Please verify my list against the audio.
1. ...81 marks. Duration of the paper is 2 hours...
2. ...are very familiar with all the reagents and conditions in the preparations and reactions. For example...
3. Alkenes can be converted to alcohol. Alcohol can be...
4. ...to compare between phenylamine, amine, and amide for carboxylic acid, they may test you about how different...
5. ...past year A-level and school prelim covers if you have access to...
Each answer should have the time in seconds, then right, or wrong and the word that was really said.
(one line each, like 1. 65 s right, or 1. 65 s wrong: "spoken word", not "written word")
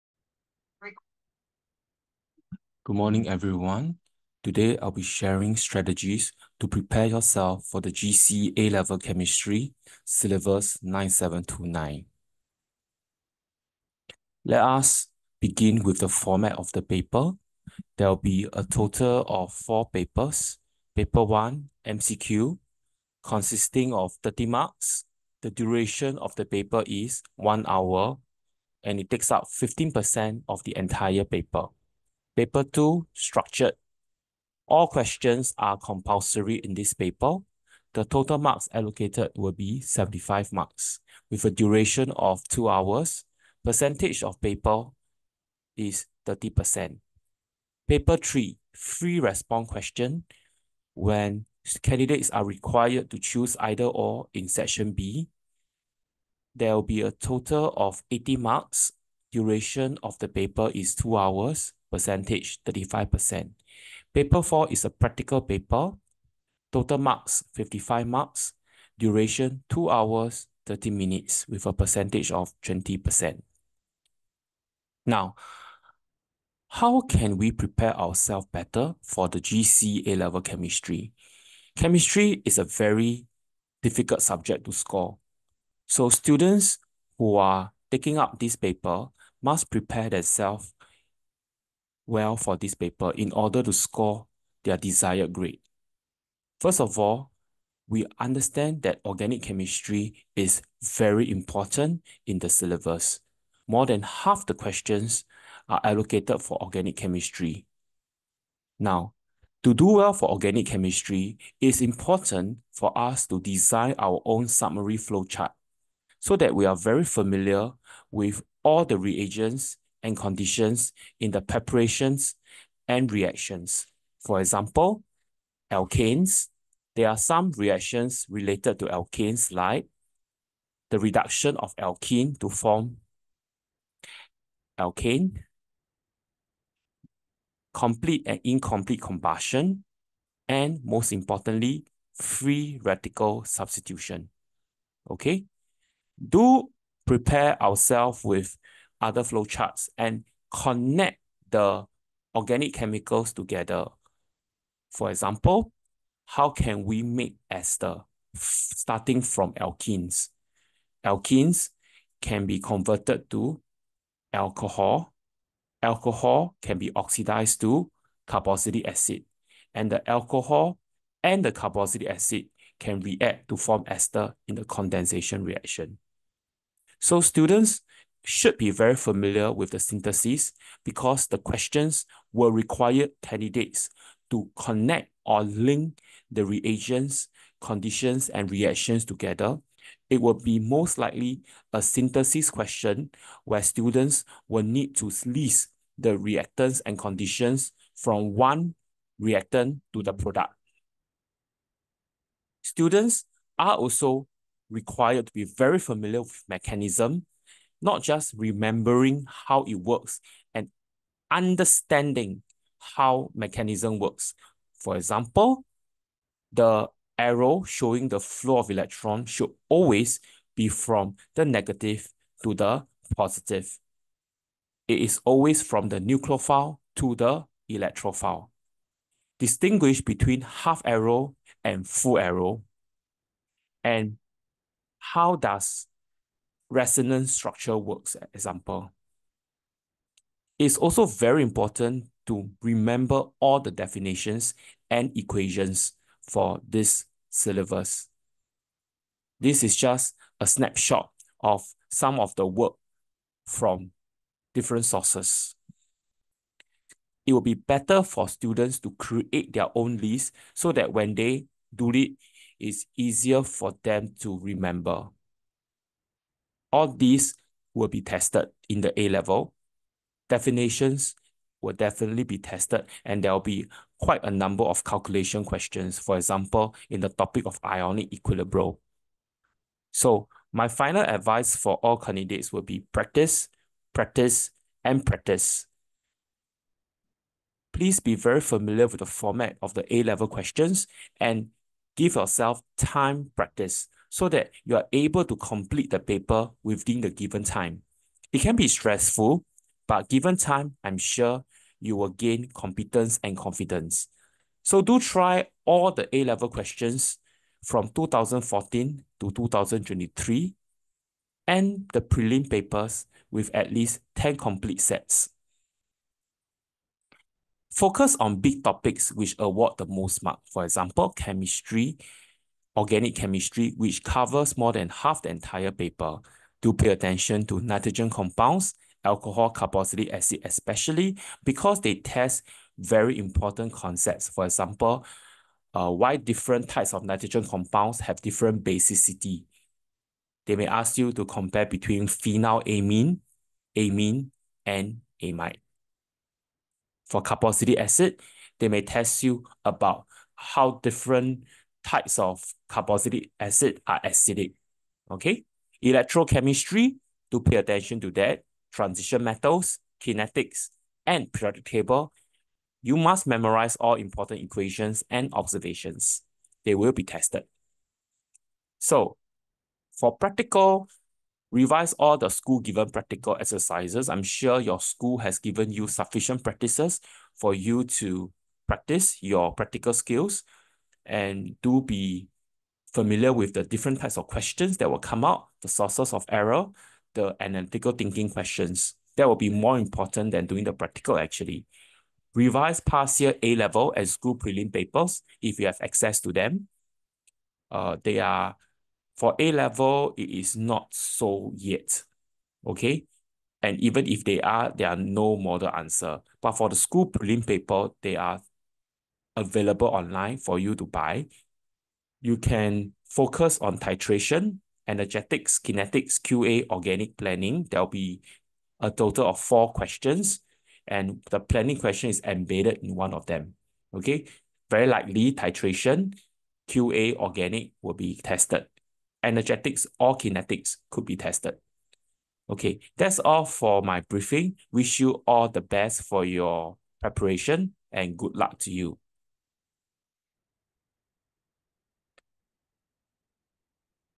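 1. 58 s wrong: "80", not "81"
2. 116 s right
3. 161 s right
4. 341 s right
5. 392 s wrong: "papers", not "covers".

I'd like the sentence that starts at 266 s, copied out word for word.
All these will be tested in the A-level.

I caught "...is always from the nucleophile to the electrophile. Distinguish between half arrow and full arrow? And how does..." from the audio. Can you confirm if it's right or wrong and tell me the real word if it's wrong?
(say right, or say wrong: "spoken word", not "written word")
right.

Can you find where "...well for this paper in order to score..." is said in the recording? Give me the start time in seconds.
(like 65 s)
92 s.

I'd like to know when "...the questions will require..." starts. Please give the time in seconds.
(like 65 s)
181 s.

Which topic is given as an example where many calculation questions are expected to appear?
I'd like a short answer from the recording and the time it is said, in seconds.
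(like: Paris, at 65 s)
ionic equilibrium, at 277 s.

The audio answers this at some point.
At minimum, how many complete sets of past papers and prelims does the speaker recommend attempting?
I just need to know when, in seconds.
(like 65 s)
314 s.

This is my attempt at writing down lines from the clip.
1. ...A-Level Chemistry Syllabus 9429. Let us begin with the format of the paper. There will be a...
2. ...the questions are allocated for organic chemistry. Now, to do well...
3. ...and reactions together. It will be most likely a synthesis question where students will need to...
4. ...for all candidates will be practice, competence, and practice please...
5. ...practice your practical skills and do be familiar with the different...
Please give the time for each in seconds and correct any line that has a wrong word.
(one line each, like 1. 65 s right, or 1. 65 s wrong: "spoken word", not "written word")
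1. 8 s wrong: "9729", not "9429"
2. 104 s right
3. 188 s right
4. 281 s wrong: "practice", not "competence"
5. 378 s right.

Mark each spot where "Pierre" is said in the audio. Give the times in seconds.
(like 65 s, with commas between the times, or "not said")
not said.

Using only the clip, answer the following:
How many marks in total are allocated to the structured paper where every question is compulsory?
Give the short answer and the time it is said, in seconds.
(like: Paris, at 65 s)
75, at 39 s.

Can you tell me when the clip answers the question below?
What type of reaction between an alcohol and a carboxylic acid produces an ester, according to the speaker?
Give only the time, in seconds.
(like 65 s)
174 s.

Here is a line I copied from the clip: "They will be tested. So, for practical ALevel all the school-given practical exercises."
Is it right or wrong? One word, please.
wrong.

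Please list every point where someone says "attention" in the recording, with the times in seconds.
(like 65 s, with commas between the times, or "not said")
326 s, 357 s.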